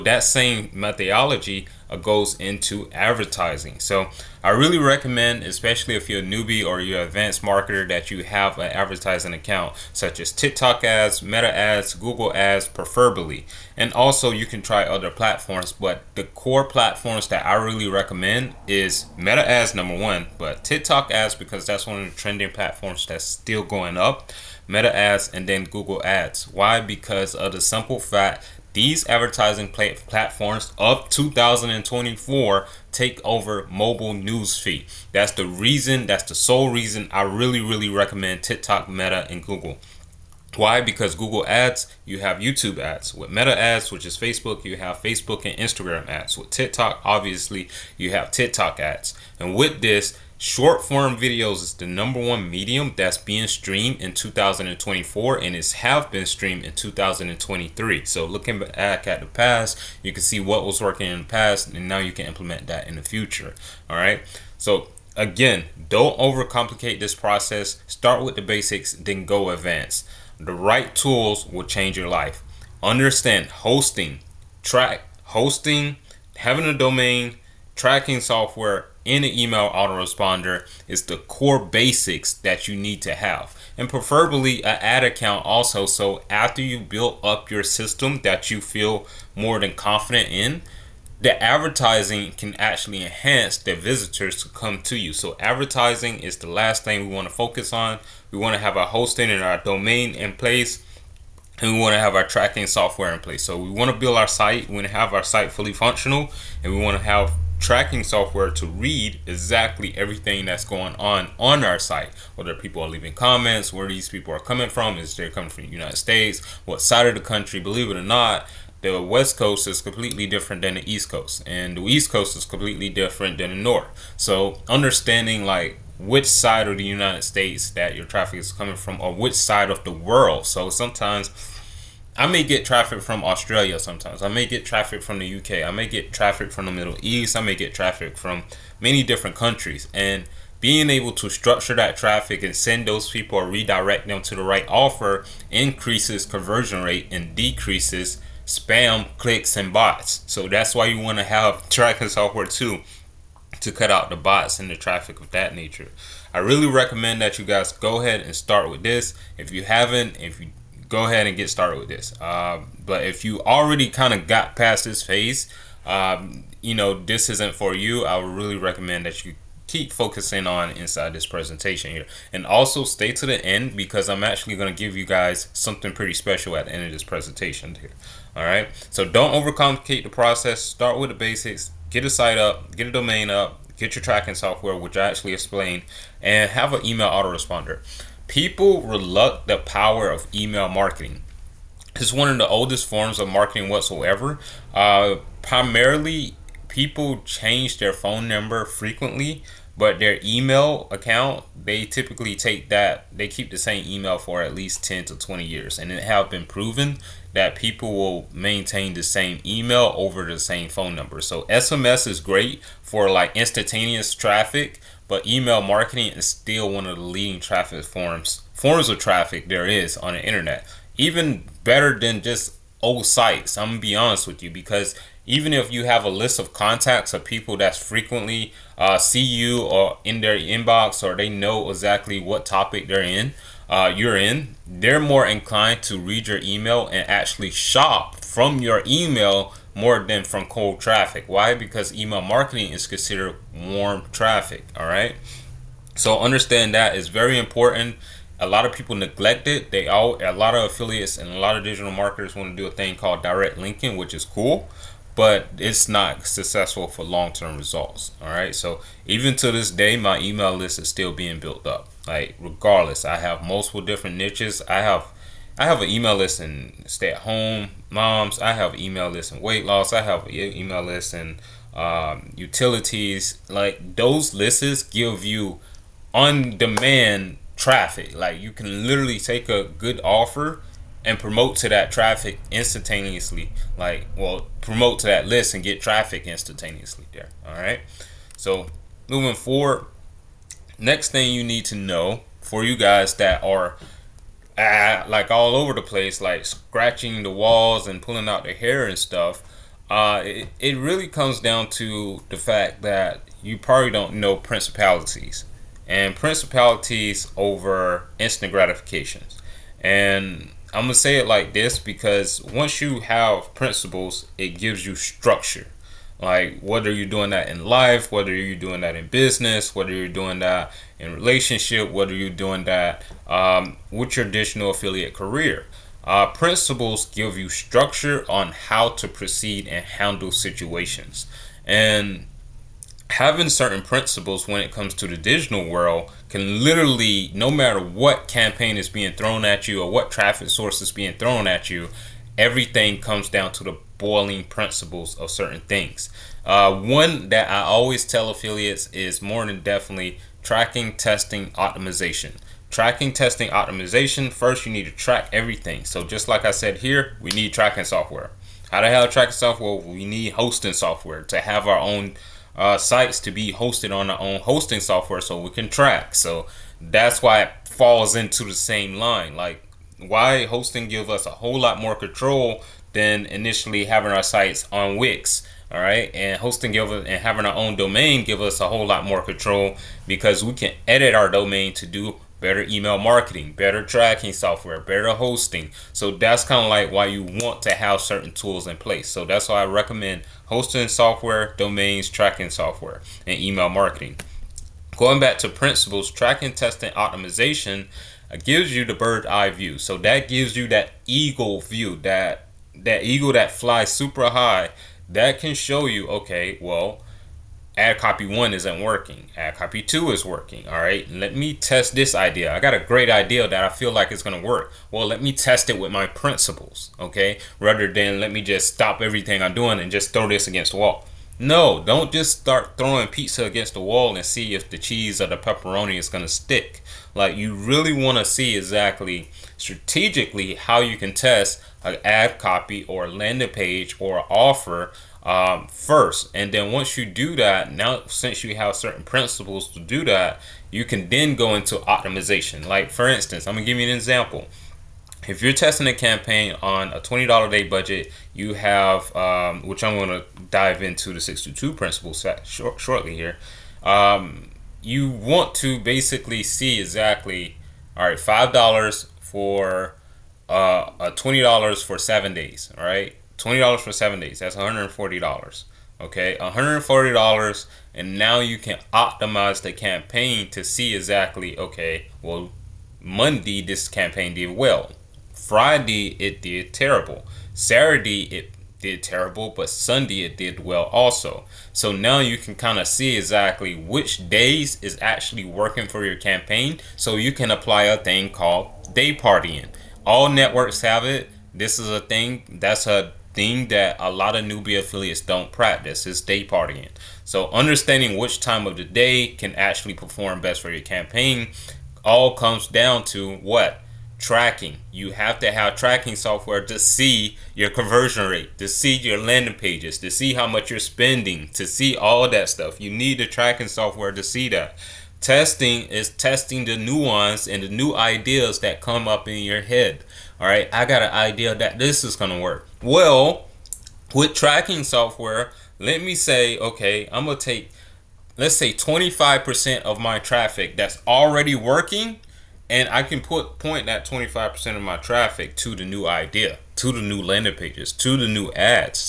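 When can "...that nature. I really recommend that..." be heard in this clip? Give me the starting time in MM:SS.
02:35.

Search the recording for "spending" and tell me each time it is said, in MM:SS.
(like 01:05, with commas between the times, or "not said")
08:30.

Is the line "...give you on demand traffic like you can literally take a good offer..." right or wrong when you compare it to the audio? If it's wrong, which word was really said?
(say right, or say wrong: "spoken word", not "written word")
right.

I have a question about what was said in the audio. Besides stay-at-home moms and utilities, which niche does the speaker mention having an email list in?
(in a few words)
Weight loss.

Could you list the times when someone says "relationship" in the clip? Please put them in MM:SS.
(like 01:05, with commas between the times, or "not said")
05:21.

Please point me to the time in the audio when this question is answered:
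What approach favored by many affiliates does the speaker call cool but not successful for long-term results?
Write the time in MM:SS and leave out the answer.
04:13.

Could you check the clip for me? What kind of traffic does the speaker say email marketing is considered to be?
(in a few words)
Warm traffic.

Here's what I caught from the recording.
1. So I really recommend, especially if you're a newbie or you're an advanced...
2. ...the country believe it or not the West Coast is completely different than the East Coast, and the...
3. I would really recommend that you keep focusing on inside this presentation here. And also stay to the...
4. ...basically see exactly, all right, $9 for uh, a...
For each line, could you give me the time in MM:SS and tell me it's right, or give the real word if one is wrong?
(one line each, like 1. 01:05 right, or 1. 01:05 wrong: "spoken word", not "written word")
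1. 00:03 right
2. 01:57 right
3. 02:48 right
4. 07:35 wrong: "5", not "9".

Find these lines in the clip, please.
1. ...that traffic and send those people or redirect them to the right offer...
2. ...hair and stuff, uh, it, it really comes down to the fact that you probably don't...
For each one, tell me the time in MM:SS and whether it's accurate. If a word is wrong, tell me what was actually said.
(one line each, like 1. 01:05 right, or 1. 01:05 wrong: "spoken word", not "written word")
1. 02:21 right
2. 04:58 right.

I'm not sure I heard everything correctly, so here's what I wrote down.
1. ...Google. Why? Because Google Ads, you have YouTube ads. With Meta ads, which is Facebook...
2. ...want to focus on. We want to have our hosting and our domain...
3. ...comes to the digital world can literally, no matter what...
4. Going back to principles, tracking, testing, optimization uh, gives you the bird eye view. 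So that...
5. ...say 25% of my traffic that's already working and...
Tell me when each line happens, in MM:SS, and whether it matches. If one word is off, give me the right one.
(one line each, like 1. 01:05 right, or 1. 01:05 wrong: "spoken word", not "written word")
1. 00:39 right
2. 01:37 right
3. 05:34 right
4. 06:34 right
5. 08:48 right.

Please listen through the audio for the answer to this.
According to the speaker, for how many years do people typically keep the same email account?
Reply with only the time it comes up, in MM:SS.
03:24.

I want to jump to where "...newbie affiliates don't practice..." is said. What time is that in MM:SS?
08:14.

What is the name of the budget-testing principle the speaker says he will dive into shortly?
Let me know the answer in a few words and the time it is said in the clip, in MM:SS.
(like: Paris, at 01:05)
622 principle, at 07:31.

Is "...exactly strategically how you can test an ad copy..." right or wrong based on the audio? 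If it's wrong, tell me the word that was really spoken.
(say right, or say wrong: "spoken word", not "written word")
right.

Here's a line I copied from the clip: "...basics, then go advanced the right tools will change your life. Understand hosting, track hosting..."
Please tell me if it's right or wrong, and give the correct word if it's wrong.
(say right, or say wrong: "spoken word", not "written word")
right.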